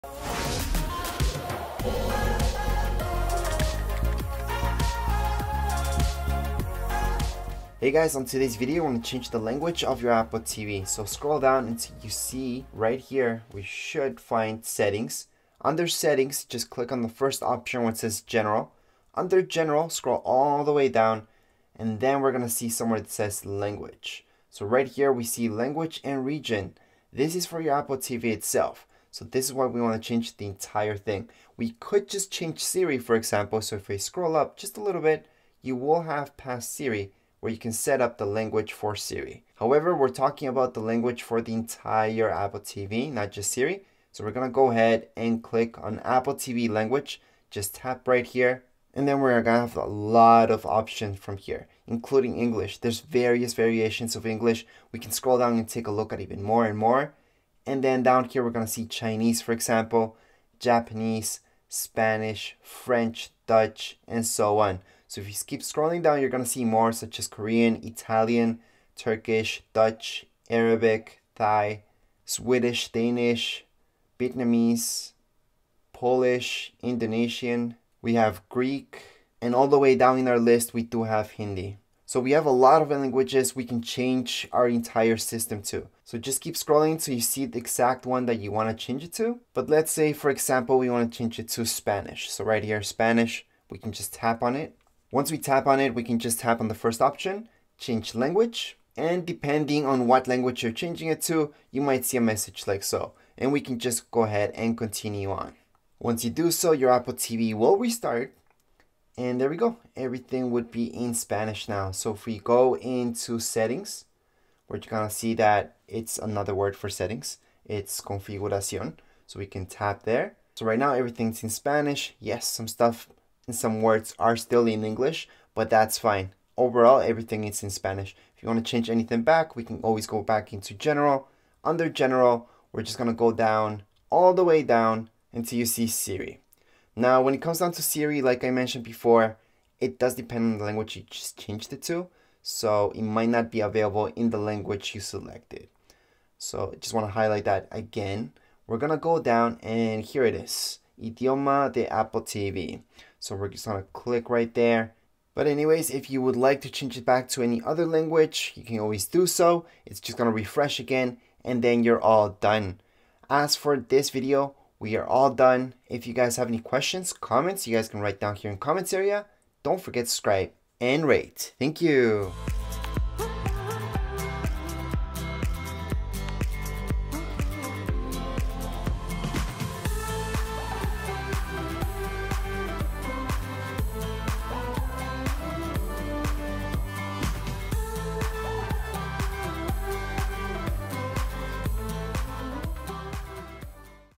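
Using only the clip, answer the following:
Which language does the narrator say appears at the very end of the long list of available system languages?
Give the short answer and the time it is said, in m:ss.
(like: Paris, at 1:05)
Hindi, at 1:21.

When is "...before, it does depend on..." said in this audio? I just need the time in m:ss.
2:18.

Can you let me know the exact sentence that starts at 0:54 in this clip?
We can scroll down and take a look at even more and more.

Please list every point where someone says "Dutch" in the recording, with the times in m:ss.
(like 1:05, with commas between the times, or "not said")
1:03, 1:09.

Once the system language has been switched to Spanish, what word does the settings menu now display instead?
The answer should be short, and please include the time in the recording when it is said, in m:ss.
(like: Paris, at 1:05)
Configuración, at 1:57.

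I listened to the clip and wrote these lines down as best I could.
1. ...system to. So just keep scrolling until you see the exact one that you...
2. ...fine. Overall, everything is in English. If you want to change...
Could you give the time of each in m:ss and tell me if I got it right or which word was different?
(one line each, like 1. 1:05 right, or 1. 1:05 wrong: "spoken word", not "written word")
1. 1:25 right
2. 2:05 wrong: "Spanish", not "English".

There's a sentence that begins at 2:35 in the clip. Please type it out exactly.
But anyways, if you would like to change it back to any other language, you can always do so.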